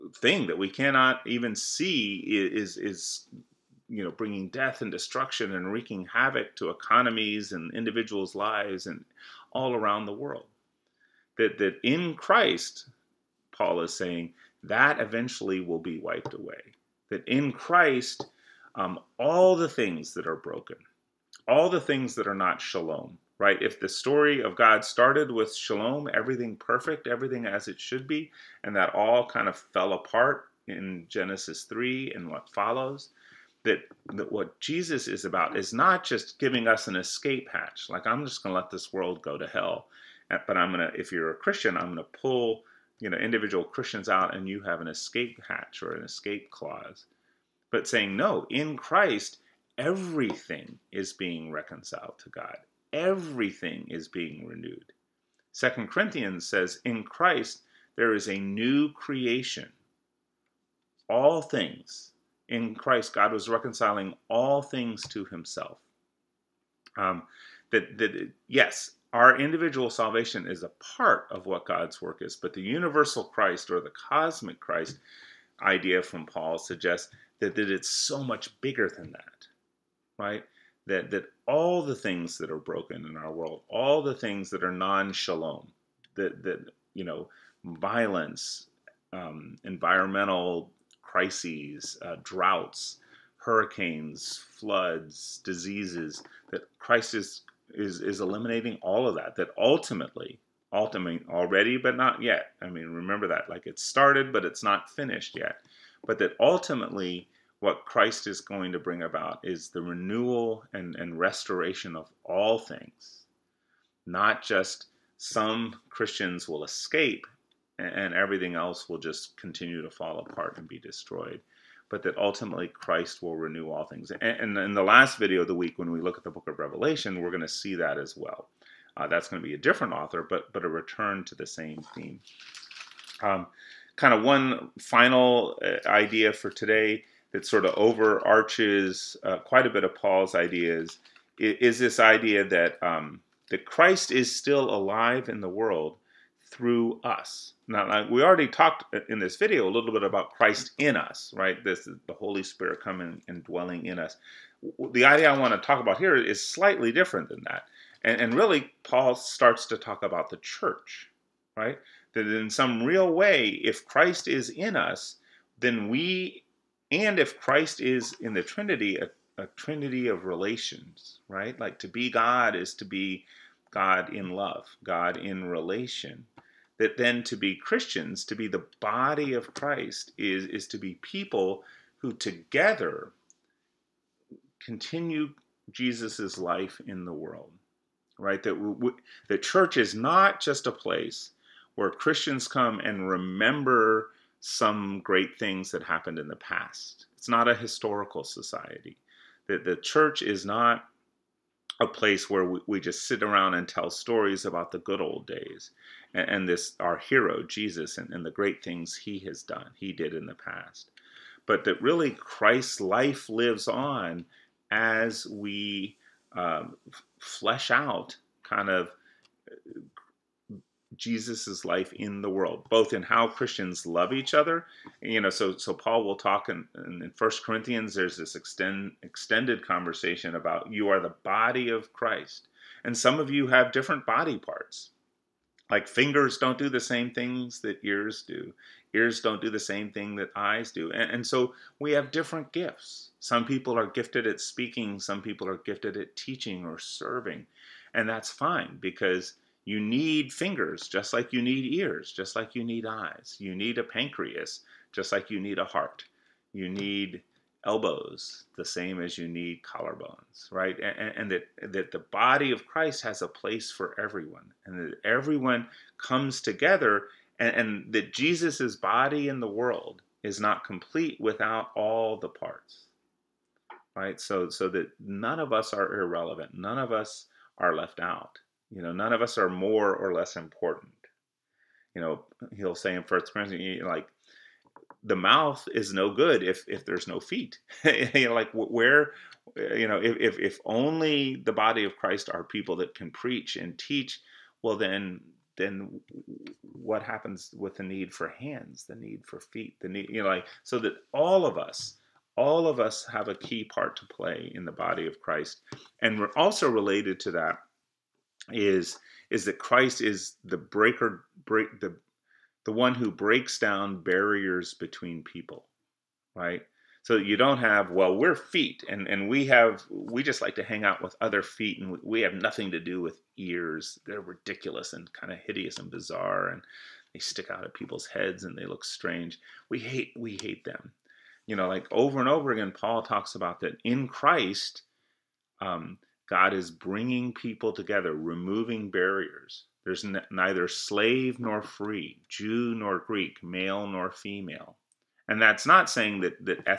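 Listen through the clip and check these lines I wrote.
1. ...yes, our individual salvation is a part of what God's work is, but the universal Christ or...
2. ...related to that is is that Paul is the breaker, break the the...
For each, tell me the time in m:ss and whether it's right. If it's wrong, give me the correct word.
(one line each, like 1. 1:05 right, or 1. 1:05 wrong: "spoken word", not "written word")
1. 1:08 right
2. 5:06 wrong: "Christ", not "Paul".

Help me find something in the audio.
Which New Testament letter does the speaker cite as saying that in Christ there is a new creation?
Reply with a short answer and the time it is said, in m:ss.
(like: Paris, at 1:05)
Second Corinthians, at 0:55.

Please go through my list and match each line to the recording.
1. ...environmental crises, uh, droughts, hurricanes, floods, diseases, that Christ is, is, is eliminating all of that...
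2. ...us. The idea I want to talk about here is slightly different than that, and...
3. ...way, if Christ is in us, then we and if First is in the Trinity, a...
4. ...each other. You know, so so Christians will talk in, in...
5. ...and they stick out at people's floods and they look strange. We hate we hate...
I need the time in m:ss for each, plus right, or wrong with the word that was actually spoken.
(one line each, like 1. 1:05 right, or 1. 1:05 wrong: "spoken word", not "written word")
1. 1:29 right
2. 2:33 right
3. 2:43 wrong: "Christ", not "First"
4. 3:44 wrong: "Paul", not "Christians"
5. 5:26 wrong: "heads", not "floods".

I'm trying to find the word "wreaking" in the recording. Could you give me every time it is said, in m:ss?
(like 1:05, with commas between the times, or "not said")
0:05.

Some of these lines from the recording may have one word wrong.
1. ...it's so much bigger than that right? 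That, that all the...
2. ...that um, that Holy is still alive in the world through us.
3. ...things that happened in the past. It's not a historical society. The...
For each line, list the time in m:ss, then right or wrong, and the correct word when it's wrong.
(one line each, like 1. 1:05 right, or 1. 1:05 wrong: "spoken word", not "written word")
1. 1:17 right
2. 2:22 wrong: "Christ", not "Holy"
3. 3:15 right.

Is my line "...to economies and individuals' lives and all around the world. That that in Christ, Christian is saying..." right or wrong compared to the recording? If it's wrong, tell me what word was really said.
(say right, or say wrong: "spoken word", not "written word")
wrong: "Paul", not "Christian".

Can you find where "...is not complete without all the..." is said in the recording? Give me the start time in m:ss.
4:30.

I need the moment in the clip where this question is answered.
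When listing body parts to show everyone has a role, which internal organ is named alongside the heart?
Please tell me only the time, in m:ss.
4:13.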